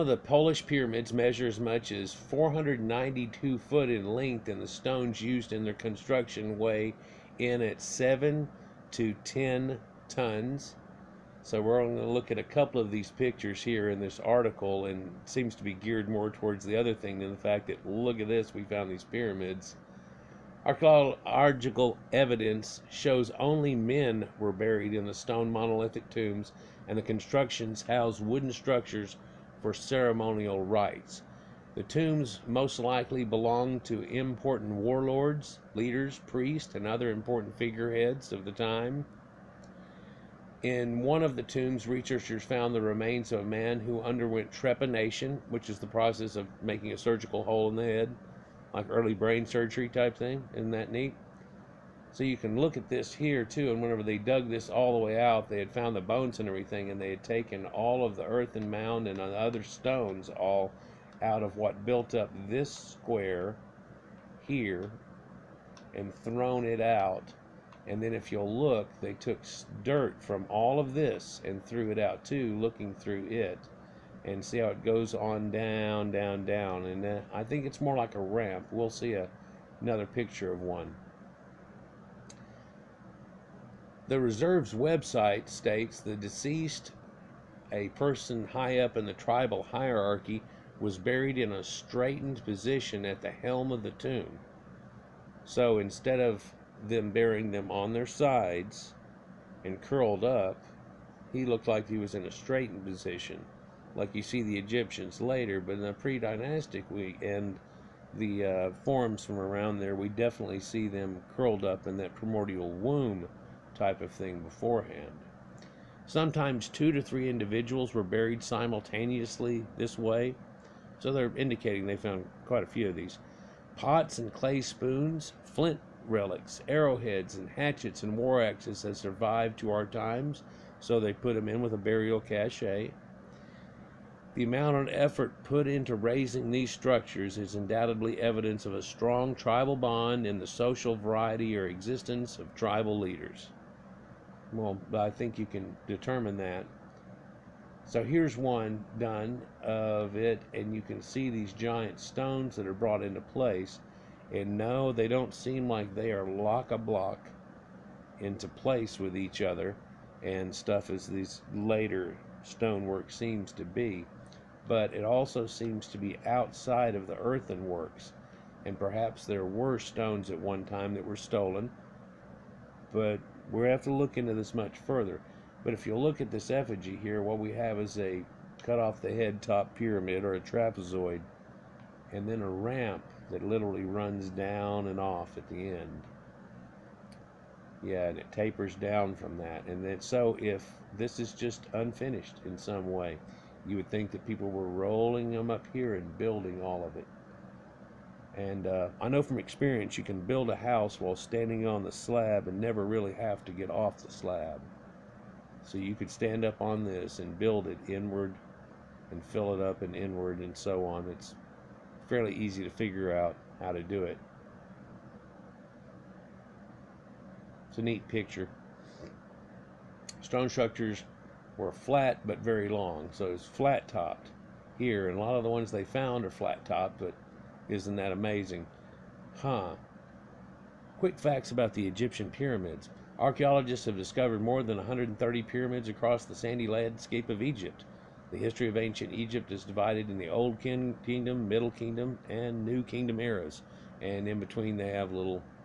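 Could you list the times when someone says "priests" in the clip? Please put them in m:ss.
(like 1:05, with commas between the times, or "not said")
0:36.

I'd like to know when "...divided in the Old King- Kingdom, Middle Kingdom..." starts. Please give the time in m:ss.
3:59.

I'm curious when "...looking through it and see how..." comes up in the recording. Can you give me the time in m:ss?
1:12.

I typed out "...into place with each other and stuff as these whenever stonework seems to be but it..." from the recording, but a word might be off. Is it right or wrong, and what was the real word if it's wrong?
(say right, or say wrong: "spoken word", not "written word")
wrong: "later", not "whenever".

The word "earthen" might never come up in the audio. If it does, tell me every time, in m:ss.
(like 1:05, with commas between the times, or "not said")
0:58, 2:47.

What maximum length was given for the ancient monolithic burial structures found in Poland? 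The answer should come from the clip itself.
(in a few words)
492 feet.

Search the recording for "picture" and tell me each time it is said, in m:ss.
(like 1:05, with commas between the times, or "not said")
0:13, 1:20, 3:38.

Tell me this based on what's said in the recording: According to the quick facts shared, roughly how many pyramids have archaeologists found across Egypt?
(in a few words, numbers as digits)
more than 130.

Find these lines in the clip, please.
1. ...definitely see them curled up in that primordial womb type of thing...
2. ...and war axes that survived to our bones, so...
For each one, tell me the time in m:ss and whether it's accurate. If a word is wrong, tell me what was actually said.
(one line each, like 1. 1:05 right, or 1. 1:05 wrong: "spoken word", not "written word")
1. 1:50 right
2. 2:08 wrong: "times", not "bones".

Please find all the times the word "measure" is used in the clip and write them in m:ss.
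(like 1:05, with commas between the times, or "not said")
0:01.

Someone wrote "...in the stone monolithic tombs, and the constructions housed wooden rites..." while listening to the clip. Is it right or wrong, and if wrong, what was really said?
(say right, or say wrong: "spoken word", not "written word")
wrong: "structures", not "rites".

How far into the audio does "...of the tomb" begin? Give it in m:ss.
1:33.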